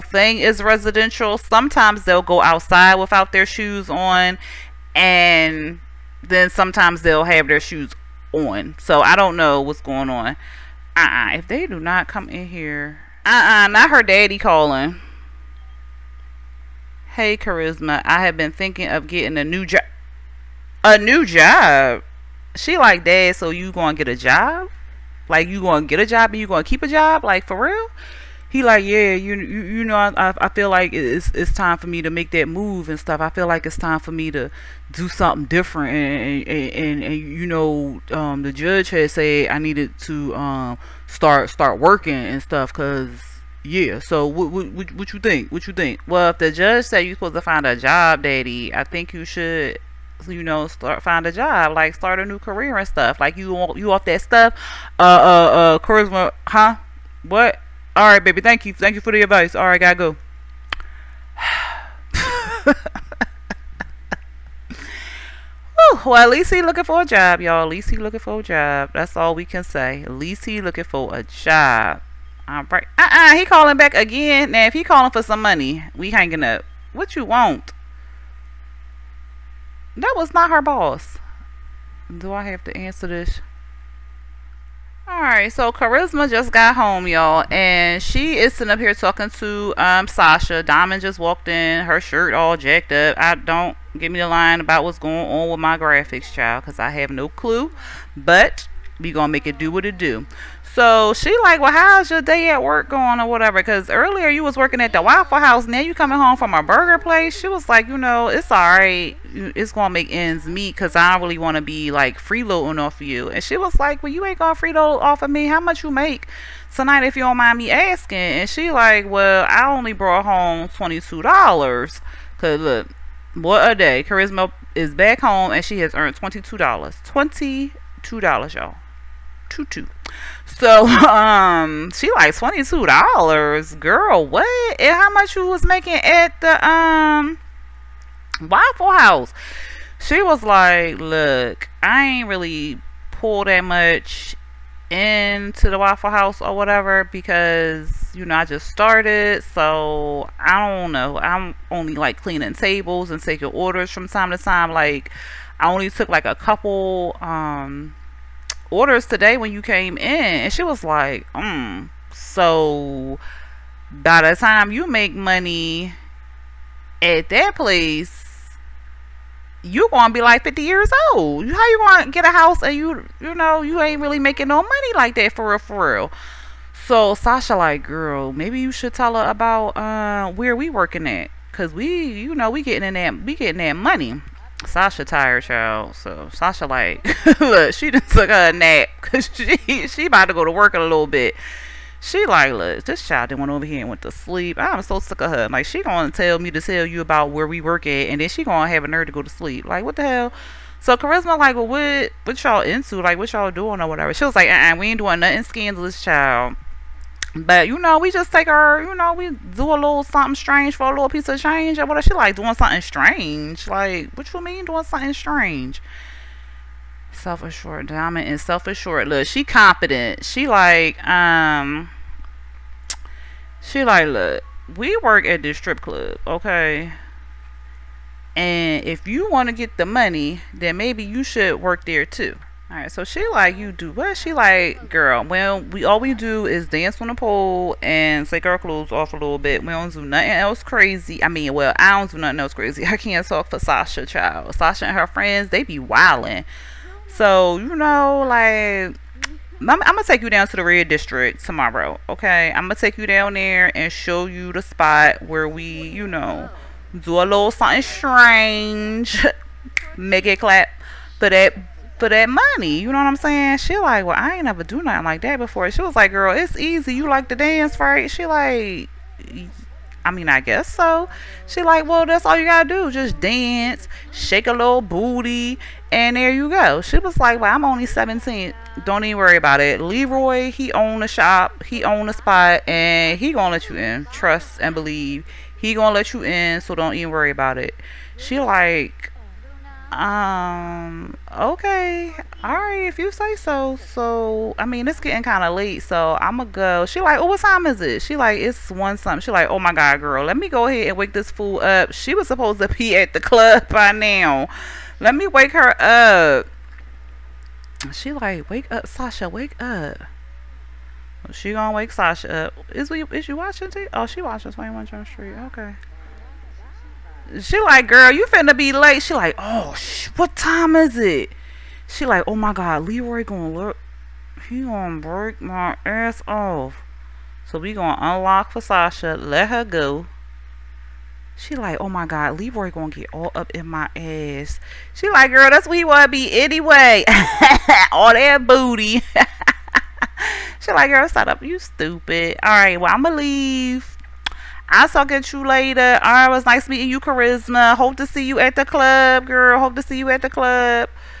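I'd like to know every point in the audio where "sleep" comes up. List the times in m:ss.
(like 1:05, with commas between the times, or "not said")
3:14, 3:19.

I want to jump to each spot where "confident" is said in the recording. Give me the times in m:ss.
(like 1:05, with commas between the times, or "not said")
3:39.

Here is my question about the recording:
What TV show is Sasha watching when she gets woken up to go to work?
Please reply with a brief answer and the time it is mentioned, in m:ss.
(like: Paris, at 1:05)
21 Jump Street, at 5:14.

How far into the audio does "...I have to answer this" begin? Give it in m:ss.
1:22.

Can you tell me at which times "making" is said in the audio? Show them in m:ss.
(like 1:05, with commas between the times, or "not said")
2:15, 2:54.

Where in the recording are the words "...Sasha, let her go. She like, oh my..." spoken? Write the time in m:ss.
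5:28.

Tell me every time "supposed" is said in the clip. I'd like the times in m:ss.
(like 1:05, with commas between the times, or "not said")
0:47, 5:02.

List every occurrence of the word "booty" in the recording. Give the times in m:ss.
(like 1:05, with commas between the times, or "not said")
4:34, 5:38.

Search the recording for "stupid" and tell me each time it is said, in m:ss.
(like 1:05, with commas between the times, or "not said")
5:41.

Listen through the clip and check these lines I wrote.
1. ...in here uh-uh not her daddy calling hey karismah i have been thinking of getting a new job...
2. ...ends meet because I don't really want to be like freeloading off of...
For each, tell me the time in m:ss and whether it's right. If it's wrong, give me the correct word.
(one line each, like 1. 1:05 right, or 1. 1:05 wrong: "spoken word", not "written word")
1. 0:12 right
2. 1:50 right.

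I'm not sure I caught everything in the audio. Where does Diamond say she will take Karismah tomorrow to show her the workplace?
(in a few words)
the red district.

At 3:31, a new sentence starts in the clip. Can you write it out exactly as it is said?
Or what she like doing something strange?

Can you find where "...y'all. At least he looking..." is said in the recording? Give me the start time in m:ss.
1:07.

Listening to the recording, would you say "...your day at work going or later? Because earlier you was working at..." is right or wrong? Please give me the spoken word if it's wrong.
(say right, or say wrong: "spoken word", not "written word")
wrong: "whatever", not "later".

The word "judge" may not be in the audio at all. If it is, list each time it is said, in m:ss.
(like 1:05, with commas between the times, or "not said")
0:38, 0:46.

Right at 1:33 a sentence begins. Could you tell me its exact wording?
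I don't give me the line about what's going on with my graphics, child, because I have no clue.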